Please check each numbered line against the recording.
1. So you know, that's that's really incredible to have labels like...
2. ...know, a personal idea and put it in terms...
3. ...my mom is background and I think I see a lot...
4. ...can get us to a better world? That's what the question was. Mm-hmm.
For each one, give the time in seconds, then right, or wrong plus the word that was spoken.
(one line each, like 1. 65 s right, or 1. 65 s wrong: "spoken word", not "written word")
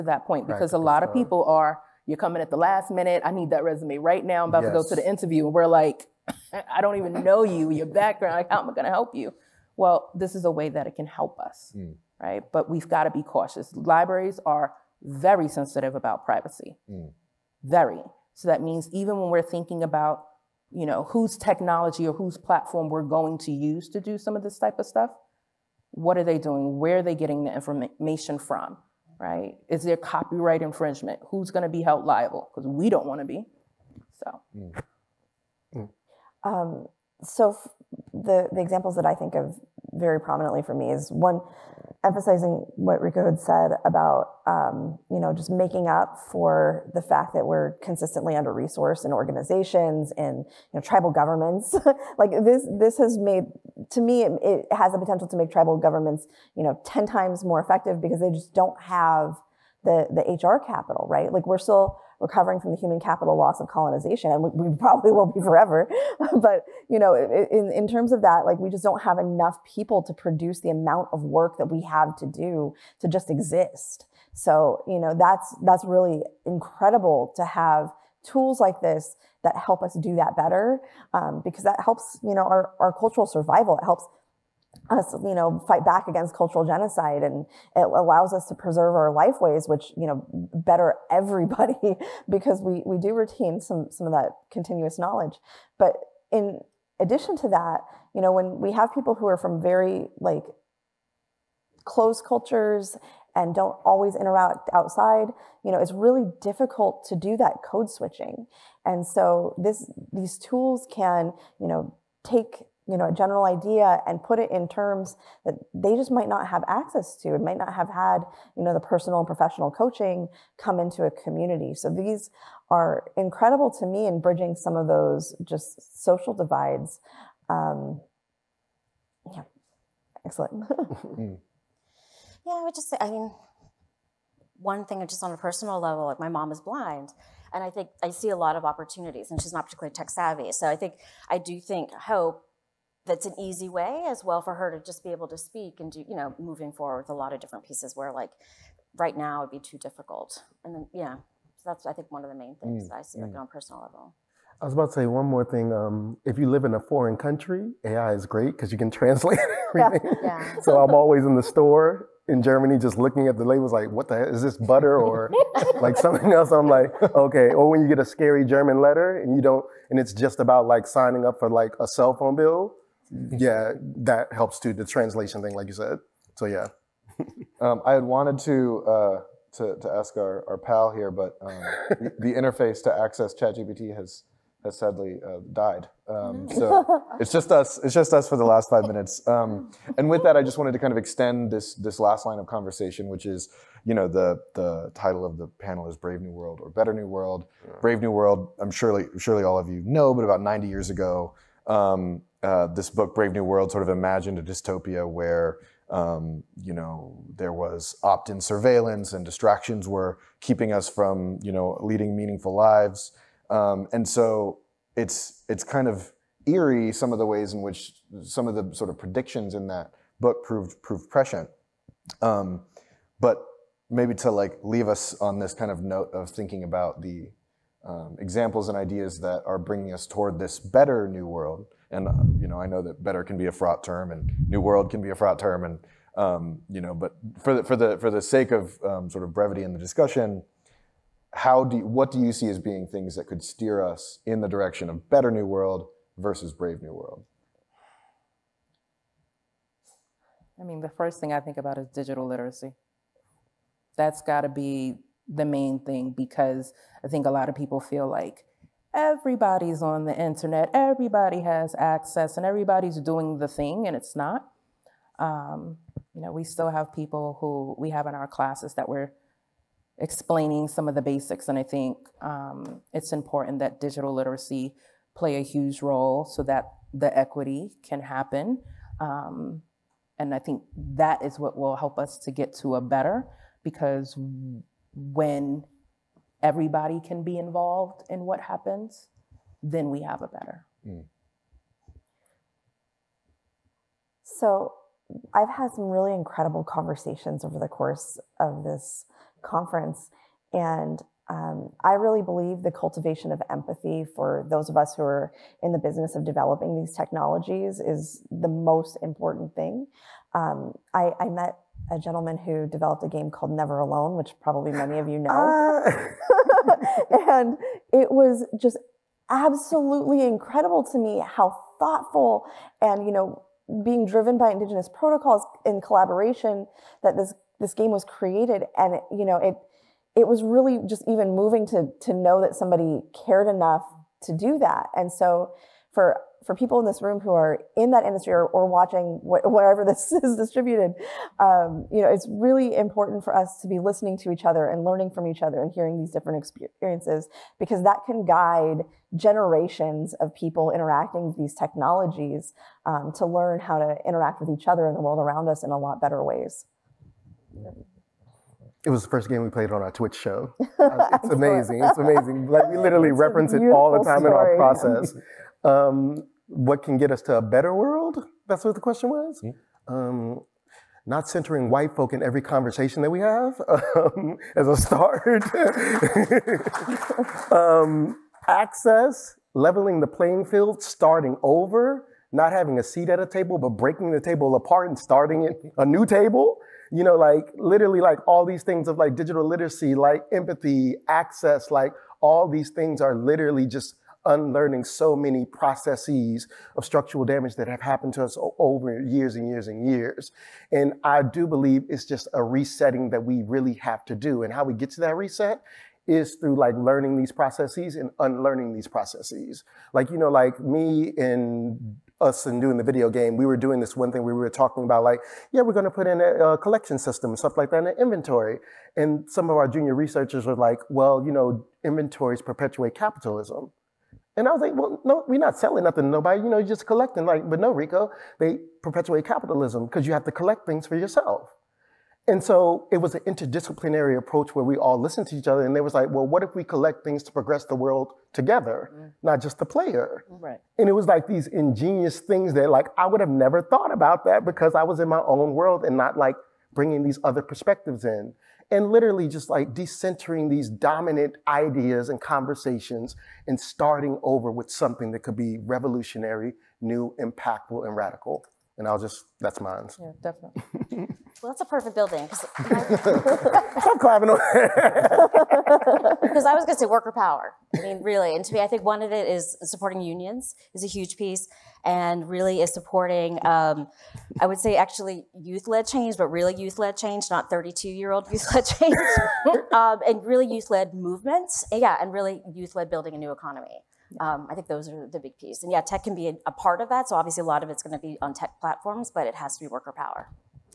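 1. 74 s wrong: "tools", not "labels"
2. 112 s wrong: "general", not "personal"
3. 136 s wrong: "blind", not "background"
4. 366 s right.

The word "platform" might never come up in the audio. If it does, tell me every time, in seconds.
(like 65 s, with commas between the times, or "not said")
22 s, 488 s.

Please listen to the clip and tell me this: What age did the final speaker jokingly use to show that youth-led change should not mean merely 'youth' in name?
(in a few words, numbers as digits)
32.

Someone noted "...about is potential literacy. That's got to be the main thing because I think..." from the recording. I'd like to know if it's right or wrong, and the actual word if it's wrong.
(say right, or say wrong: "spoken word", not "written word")
wrong: "digital", not "potential".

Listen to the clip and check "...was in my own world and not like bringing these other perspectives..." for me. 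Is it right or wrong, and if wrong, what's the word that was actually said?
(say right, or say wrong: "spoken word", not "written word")
right.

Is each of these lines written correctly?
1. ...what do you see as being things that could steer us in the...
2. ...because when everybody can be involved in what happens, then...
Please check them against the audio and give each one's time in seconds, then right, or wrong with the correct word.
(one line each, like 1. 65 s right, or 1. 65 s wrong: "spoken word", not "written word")
1. 241 s right
2. 283 s right.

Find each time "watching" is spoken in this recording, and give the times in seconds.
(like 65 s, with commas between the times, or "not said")
338 s.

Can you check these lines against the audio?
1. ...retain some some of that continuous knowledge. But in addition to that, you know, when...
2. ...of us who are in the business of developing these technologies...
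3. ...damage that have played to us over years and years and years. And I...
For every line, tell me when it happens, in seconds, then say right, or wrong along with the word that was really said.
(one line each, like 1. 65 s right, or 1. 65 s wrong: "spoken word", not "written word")
1. 93 s right
2. 304 s right
3. 397 s wrong: "happened", not "played".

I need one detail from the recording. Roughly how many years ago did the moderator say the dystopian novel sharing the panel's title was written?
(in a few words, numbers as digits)
90 years.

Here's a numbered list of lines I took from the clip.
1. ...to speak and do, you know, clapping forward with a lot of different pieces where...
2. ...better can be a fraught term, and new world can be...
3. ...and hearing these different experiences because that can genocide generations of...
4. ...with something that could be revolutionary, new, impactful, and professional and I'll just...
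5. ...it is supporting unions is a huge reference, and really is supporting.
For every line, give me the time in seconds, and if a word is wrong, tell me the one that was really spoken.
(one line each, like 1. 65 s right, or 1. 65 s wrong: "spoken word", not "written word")
1. 145 s wrong: "moving", not "clapping"
2. 233 s right
3. 345 s wrong: "guide", not "genocide"
4. 454 s wrong: "radical", not "professional"
5. 469 s wrong: "piece", not "reference".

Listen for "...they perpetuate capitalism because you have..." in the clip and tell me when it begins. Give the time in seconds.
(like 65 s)
428 s.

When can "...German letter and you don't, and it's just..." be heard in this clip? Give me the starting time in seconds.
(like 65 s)
168 s.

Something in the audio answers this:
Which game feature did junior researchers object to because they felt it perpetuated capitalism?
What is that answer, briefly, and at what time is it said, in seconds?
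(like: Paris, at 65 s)
Inventory, at 417 s.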